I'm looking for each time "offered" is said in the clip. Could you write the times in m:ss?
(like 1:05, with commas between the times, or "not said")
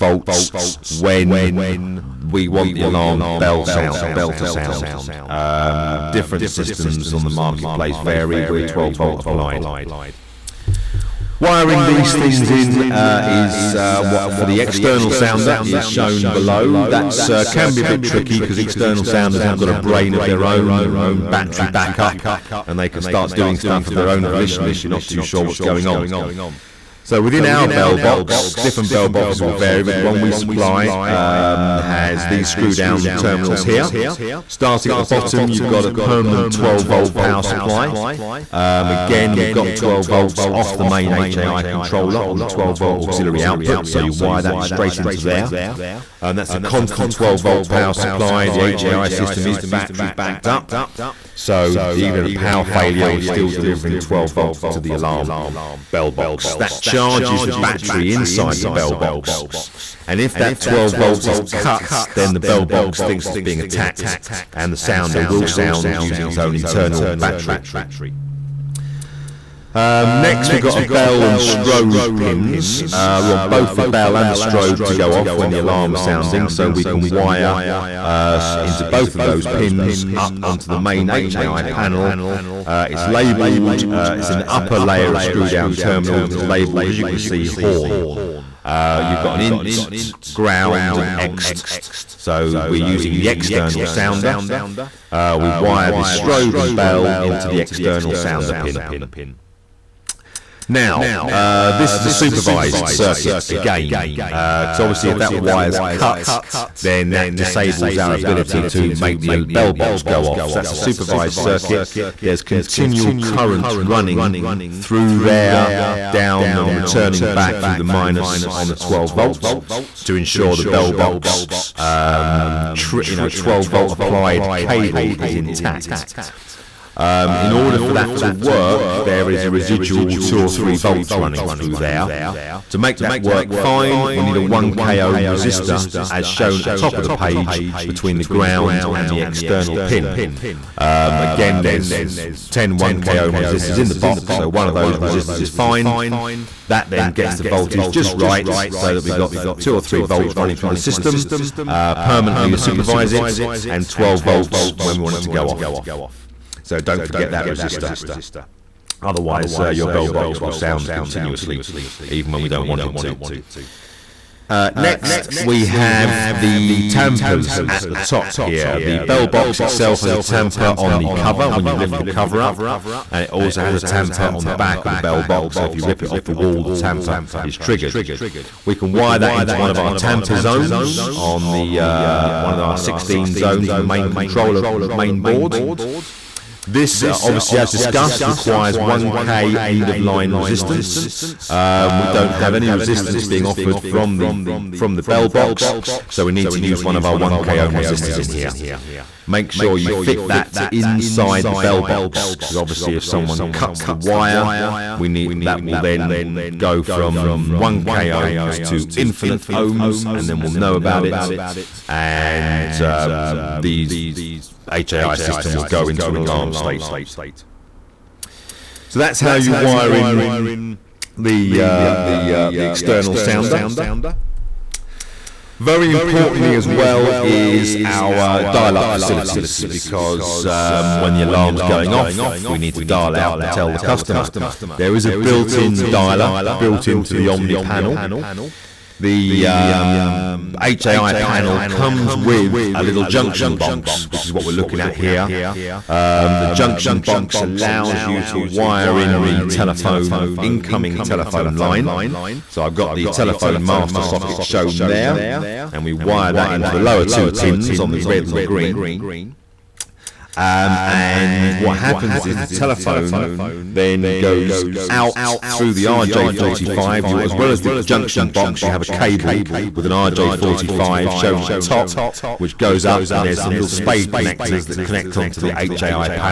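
3:13.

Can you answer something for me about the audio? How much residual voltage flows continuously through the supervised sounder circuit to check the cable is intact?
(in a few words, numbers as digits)
2 or 3 volts.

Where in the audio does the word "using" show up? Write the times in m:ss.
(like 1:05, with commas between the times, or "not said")
1:05, 1:32.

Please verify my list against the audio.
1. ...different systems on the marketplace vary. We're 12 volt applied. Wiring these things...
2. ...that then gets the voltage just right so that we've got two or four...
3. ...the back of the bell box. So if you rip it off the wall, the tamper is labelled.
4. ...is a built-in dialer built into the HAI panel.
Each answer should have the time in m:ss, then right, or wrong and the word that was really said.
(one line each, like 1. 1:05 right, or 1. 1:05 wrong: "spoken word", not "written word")
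1. 0:06 right
2. 2:26 wrong: "three", not "four"
3. 2:54 wrong: "triggered", not "labelled"
4. 3:54 wrong: "Omni", not "HAI".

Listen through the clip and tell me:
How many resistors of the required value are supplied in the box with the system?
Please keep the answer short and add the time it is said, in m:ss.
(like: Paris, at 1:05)
10, at 2:22.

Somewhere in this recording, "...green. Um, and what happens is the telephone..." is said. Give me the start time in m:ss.
4:18.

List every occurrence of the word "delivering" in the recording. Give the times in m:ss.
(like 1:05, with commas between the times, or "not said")
0:53.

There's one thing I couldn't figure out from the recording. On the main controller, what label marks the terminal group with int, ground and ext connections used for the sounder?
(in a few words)
horn.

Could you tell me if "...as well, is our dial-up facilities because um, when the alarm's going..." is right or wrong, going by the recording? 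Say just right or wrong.
right.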